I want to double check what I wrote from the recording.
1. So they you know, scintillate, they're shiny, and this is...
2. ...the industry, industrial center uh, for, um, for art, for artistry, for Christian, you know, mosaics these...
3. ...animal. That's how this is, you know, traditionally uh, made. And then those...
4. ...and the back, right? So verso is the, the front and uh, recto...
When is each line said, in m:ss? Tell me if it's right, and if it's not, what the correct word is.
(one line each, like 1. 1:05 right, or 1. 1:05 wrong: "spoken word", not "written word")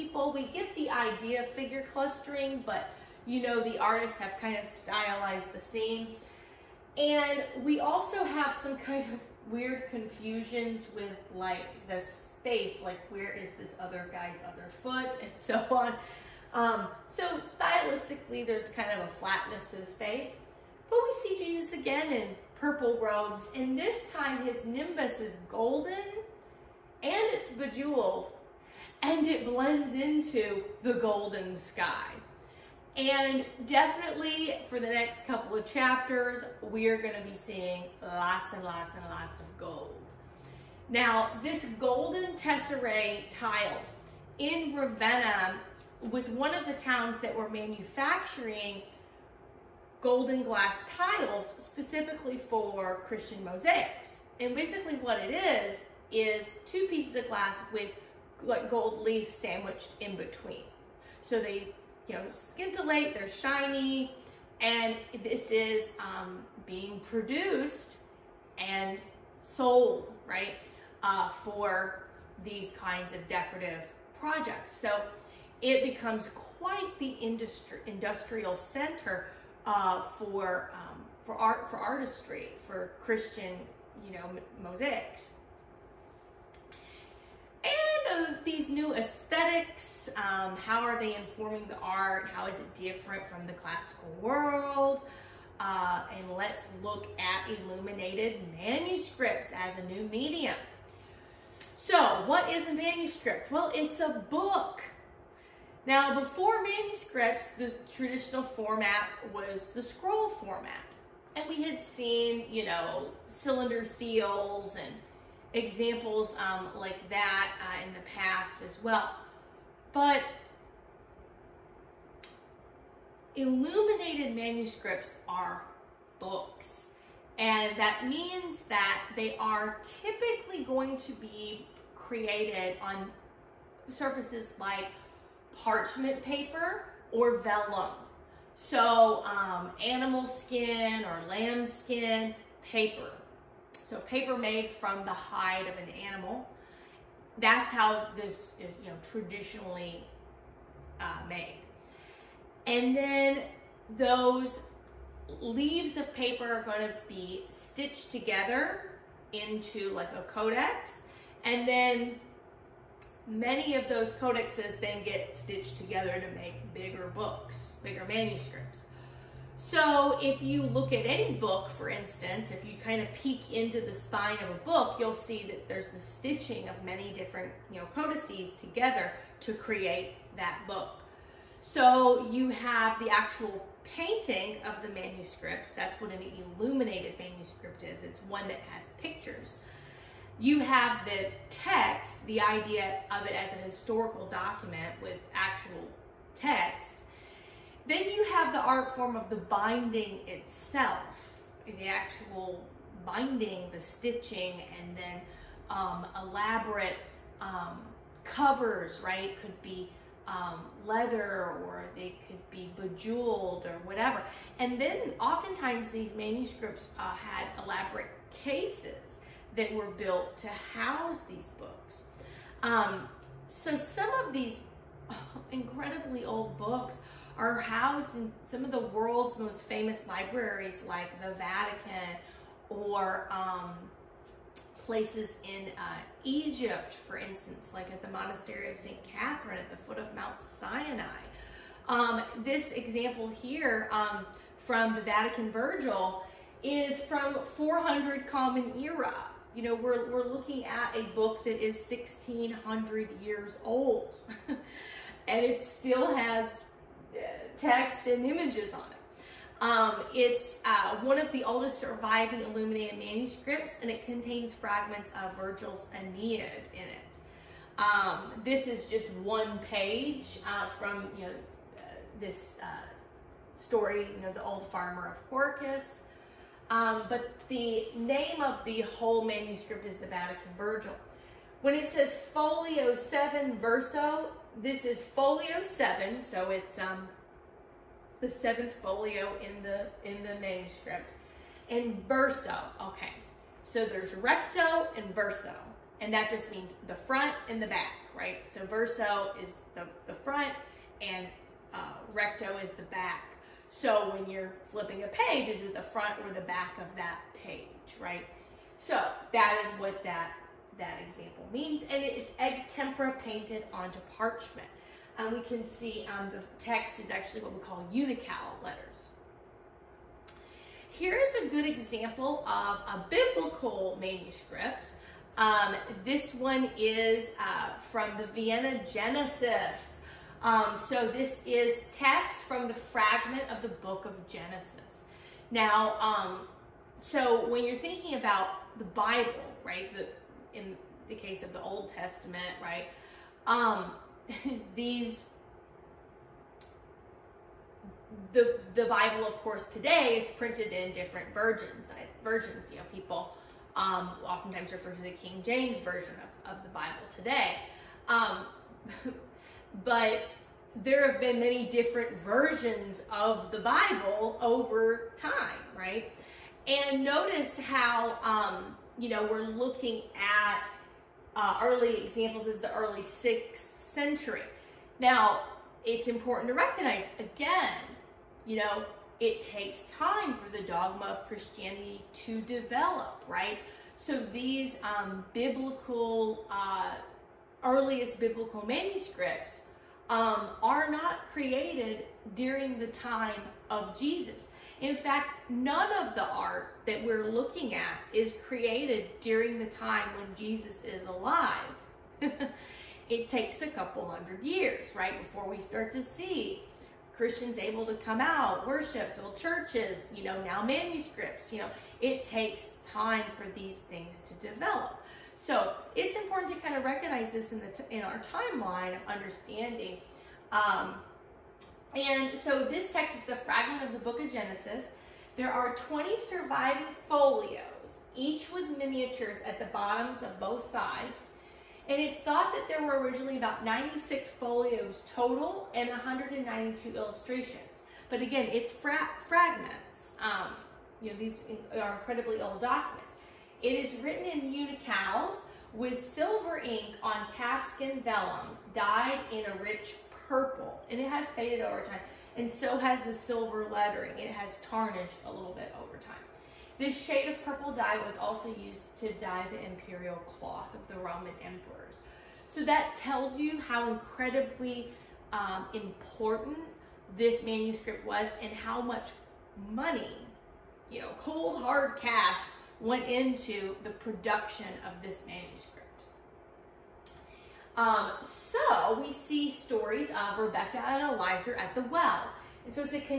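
1. 1:01 right
2. 1:16 right
3. 2:25 right
4. 4:57 right.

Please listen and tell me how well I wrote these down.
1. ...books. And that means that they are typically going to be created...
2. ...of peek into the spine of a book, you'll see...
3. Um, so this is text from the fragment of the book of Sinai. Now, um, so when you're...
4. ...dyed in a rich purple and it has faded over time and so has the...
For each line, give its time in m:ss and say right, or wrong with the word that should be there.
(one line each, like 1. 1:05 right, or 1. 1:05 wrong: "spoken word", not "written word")
1. 2:06 right
2. 2:53 right
3. 5:30 wrong: "Genesis", not "Sinai"
4. 7:28 right.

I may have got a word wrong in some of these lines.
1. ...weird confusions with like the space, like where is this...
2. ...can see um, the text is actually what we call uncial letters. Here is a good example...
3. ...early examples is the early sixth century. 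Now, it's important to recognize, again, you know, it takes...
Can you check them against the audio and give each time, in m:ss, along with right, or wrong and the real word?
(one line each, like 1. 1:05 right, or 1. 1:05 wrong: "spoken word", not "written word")
1. 0:09 right
2. 5:15 right
3. 6:11 right.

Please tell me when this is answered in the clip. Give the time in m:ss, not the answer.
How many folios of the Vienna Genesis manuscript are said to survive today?
7:05.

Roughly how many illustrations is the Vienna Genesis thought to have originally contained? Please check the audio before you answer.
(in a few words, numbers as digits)
192.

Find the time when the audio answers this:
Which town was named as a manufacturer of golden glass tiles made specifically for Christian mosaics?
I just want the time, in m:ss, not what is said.
0:44.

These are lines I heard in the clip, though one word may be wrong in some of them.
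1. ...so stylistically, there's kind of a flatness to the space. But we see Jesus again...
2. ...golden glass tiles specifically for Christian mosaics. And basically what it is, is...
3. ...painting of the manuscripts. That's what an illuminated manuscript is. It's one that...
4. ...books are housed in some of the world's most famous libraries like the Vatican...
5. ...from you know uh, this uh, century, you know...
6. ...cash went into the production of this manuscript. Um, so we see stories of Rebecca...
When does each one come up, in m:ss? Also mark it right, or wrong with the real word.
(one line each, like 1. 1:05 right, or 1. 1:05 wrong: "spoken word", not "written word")
1. 0:17 right
2. 0:50 right
3. 3:03 right
4. 3:46 right
5. 4:30 wrong: "story", not "century"
6. 7:51 right.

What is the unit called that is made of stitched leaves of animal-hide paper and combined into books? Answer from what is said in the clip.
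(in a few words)
codex.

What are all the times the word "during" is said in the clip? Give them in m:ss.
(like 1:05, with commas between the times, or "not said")
6:32, 6:39.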